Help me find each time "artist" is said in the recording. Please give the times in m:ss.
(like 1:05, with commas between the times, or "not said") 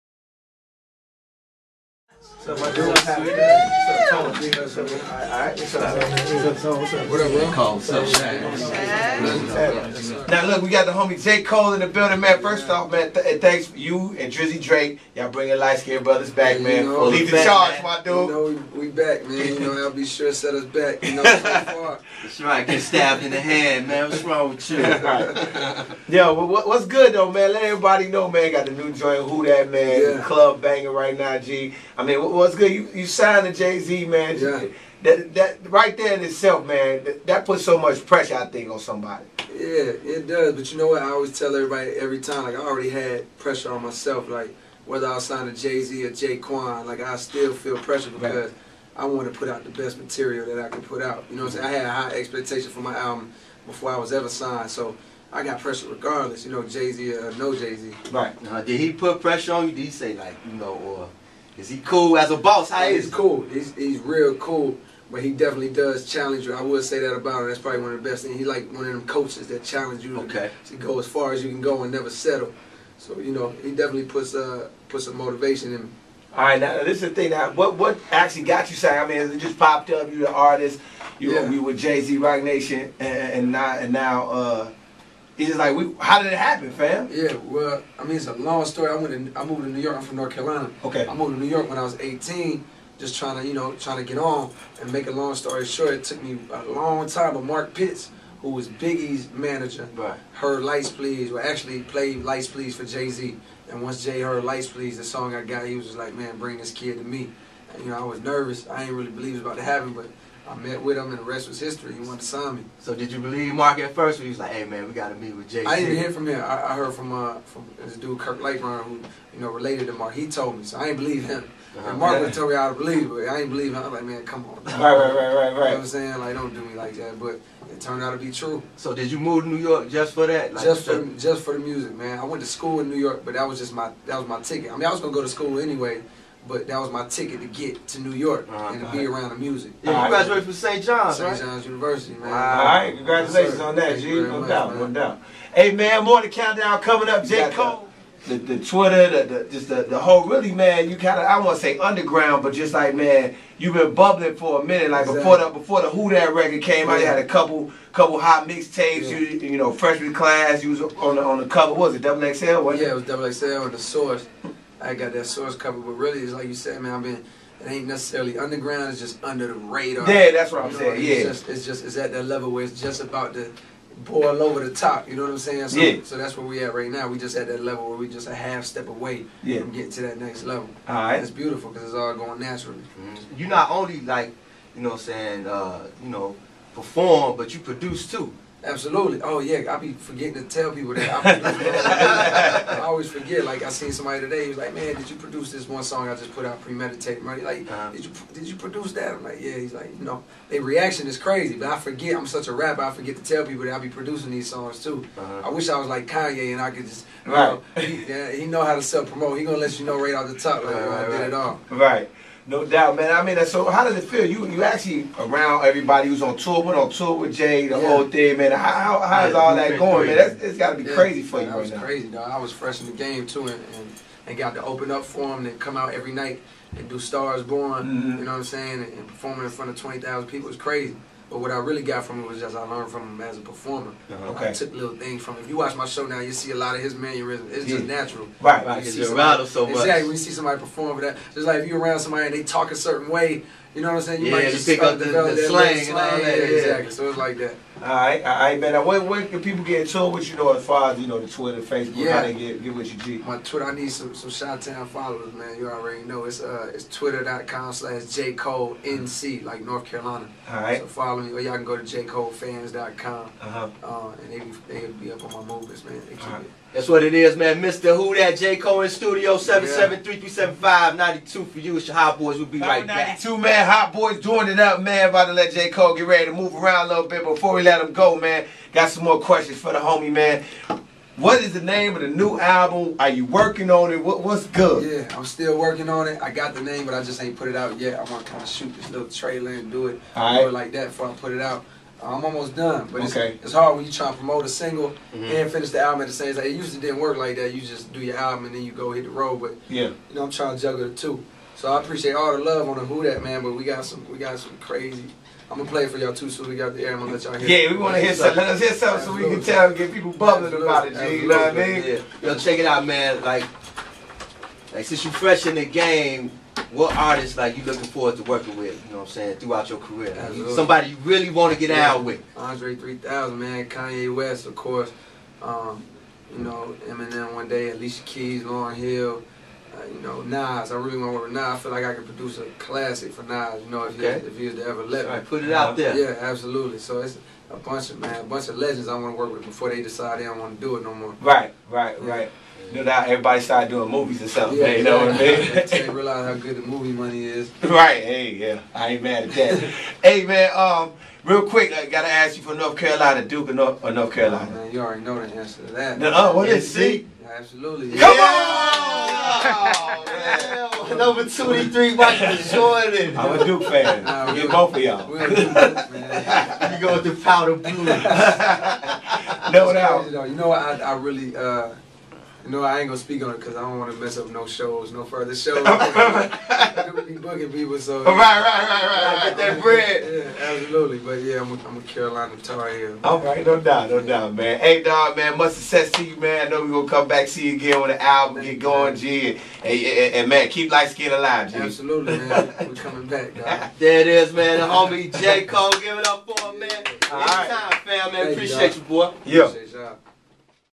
1:20, 5:16.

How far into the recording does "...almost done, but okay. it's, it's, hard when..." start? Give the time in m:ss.
4:52.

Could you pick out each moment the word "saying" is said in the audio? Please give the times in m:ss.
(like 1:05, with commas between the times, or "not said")
0:51, 2:05, 2:50, 2:55, 3:05, 3:48, 4:04, 5:19.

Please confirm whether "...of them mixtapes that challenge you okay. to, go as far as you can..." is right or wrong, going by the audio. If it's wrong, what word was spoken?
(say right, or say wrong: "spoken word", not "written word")
wrong: "coaches", not "mixtapes".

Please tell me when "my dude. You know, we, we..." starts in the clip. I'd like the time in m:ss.
0:17.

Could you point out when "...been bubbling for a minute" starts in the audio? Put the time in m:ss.
2:33.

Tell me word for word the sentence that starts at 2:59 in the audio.
from getting to that next level.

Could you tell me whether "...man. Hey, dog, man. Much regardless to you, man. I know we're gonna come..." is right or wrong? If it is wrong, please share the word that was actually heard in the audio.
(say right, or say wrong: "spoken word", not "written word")
wrong: "success", not "regardless".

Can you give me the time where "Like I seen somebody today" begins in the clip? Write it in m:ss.
3:13.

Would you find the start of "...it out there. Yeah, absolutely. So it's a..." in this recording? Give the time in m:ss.
5:35.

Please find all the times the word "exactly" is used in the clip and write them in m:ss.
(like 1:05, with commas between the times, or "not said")
2:35, 3:59, 4:06.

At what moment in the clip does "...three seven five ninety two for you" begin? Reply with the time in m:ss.
4:30.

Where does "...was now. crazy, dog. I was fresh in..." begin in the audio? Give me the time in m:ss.
3:41.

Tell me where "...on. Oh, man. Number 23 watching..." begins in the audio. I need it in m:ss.
5:58.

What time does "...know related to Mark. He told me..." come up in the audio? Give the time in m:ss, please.
1:59.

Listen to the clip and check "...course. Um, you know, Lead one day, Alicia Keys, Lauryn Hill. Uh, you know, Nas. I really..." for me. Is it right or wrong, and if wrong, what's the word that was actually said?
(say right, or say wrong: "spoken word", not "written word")
wrong: "Eminem", not "Lead".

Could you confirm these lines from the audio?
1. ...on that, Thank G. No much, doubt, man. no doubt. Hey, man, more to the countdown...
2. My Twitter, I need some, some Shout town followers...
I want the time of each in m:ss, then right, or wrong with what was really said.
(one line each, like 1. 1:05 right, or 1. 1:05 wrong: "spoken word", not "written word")
1. 2:23 right
2. 4:13 right.